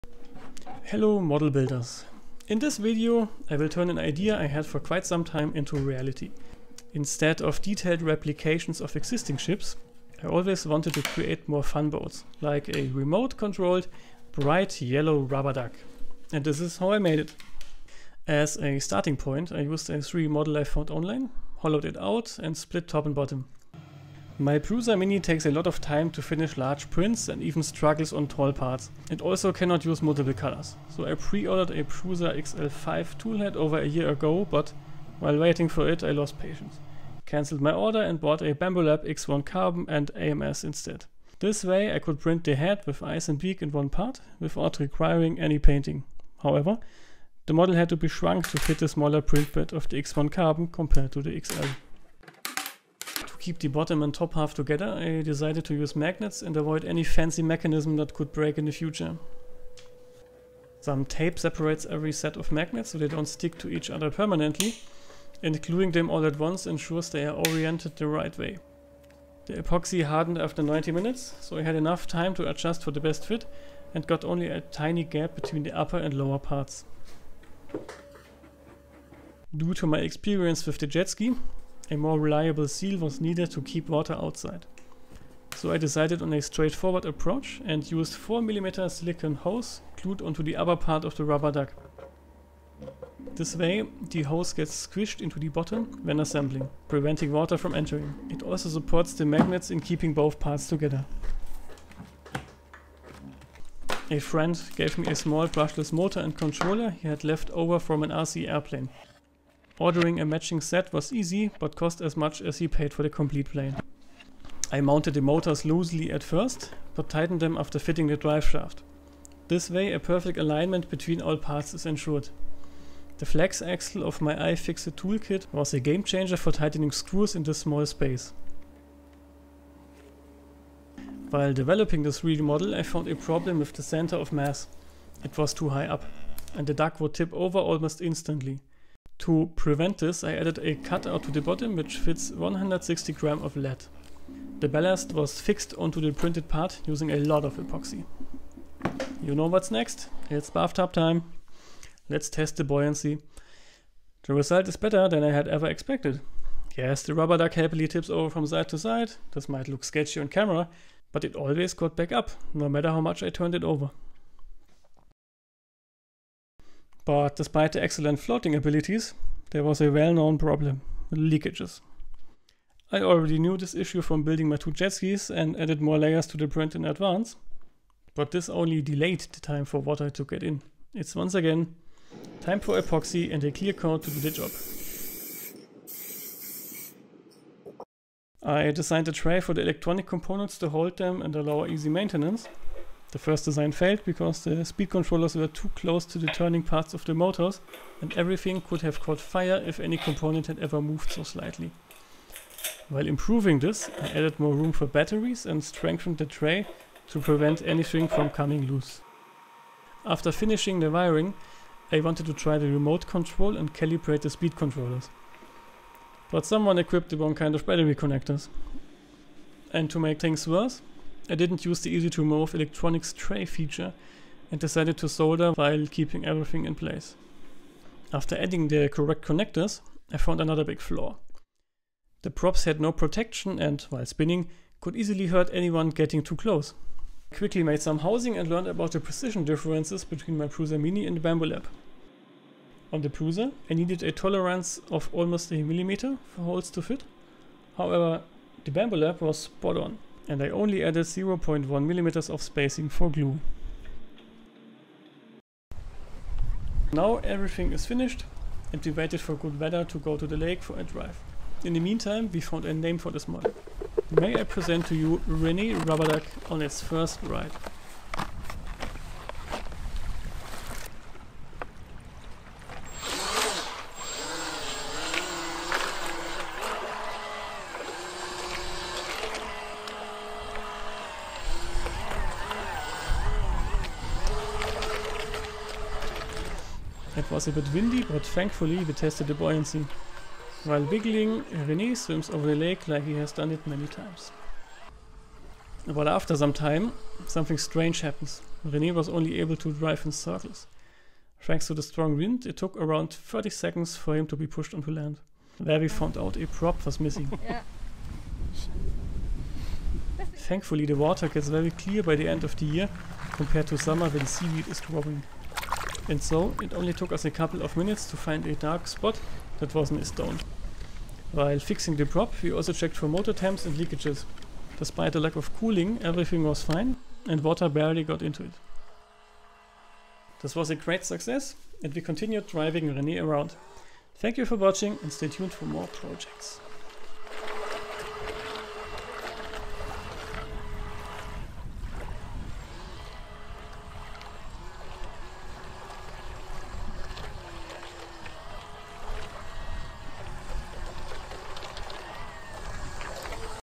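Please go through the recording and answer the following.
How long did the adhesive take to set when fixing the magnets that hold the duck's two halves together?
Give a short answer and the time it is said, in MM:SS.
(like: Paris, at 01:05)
90 minutes, at 01:10.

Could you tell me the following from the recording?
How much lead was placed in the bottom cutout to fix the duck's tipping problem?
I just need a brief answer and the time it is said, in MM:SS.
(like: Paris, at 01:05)
160 grams, at 02:22.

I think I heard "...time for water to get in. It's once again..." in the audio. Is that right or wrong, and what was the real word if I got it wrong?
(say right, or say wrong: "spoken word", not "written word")
right.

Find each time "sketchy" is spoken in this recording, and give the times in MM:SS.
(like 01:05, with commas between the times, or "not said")
02:39.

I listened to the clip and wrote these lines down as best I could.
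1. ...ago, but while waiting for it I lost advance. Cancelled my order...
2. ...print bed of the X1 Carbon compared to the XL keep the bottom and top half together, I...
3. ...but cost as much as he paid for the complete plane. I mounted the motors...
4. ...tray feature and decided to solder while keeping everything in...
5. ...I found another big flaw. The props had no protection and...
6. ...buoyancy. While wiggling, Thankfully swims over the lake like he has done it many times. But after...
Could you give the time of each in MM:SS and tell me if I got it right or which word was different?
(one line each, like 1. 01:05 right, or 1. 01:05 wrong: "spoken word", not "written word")
1. 00:34 wrong: "patience", not "advance"
2. 00:49 right
3. 01:51 right
4. 03:43 right
5. 03:50 right
6. 04:49 wrong: "René", not "Thankfully".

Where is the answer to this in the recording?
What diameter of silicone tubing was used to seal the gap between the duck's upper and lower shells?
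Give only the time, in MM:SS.
01:28.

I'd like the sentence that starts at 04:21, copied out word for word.
In the meantime we found a name for this model.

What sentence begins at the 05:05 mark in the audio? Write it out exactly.
There we found out a prop was missing.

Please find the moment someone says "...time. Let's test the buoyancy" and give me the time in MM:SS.
02:30.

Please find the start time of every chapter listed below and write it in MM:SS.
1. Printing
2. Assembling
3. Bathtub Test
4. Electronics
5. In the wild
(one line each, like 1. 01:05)
1. 00:23
2. 00:53
3. 02:30
4. 03:07
5. 04:15.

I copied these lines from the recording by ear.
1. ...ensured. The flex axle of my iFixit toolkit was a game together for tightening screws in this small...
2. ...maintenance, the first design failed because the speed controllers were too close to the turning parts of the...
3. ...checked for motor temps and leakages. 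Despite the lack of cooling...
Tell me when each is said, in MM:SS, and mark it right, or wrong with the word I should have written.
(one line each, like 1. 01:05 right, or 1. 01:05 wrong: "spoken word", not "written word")
1. 02:01 wrong: "changer", not "together"
2. 03:11 right
3. 05:22 right.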